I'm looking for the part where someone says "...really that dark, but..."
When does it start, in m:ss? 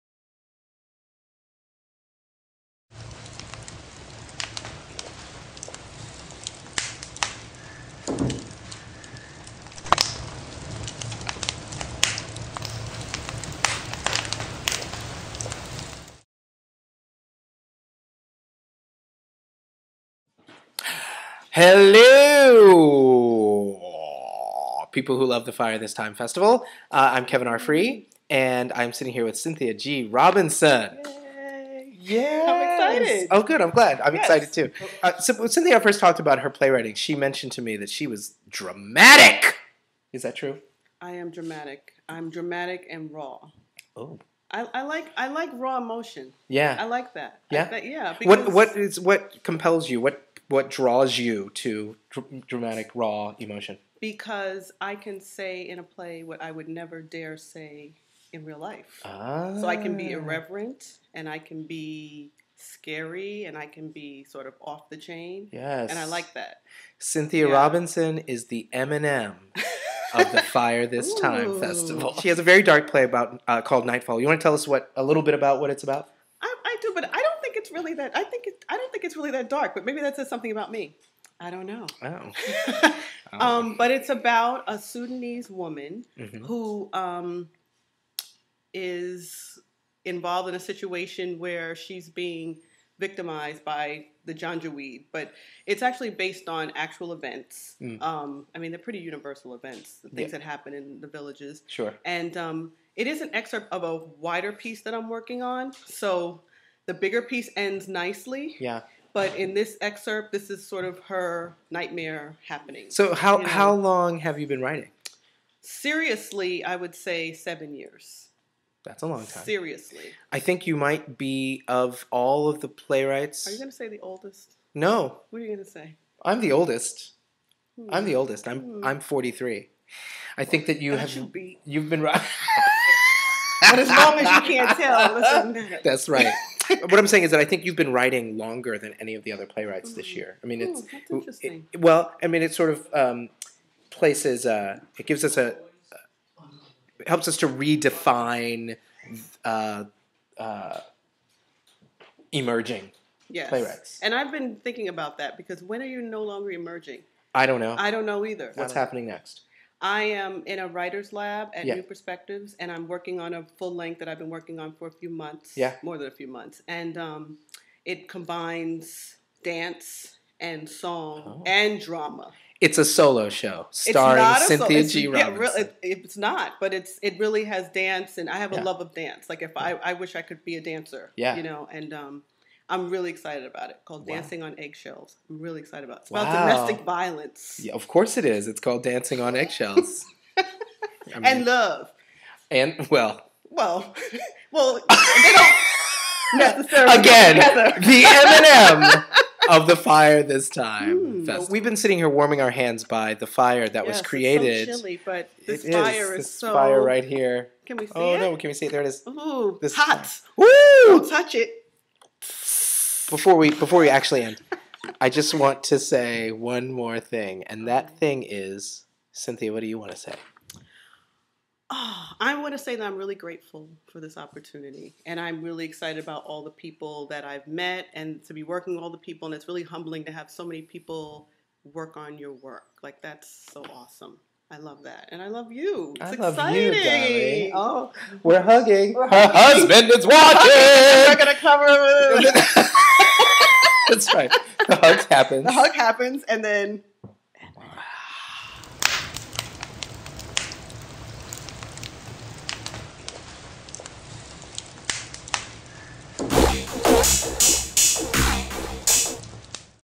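1:19.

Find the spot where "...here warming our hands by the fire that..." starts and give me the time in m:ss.
3:21.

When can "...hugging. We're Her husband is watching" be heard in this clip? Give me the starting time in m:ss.
3:58.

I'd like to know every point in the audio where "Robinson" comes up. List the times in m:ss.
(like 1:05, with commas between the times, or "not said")
0:30, 1:07, 2:55.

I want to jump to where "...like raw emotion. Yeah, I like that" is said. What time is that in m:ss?
0:45.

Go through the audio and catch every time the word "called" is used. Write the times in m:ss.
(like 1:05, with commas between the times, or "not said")
1:13, 3:03, 3:08.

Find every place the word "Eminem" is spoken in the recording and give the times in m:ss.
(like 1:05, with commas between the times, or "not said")
1:08, 3:18.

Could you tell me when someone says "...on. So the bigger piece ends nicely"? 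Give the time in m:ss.
1:45.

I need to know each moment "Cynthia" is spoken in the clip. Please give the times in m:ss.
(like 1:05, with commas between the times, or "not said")
0:29, 0:35, 1:06, 2:54, 3:39.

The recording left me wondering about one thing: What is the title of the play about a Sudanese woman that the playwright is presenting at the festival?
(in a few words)
Nightfall.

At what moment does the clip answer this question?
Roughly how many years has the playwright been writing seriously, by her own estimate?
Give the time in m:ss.
1:57.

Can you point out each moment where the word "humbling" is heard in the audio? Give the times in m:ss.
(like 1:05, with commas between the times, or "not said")
3:49.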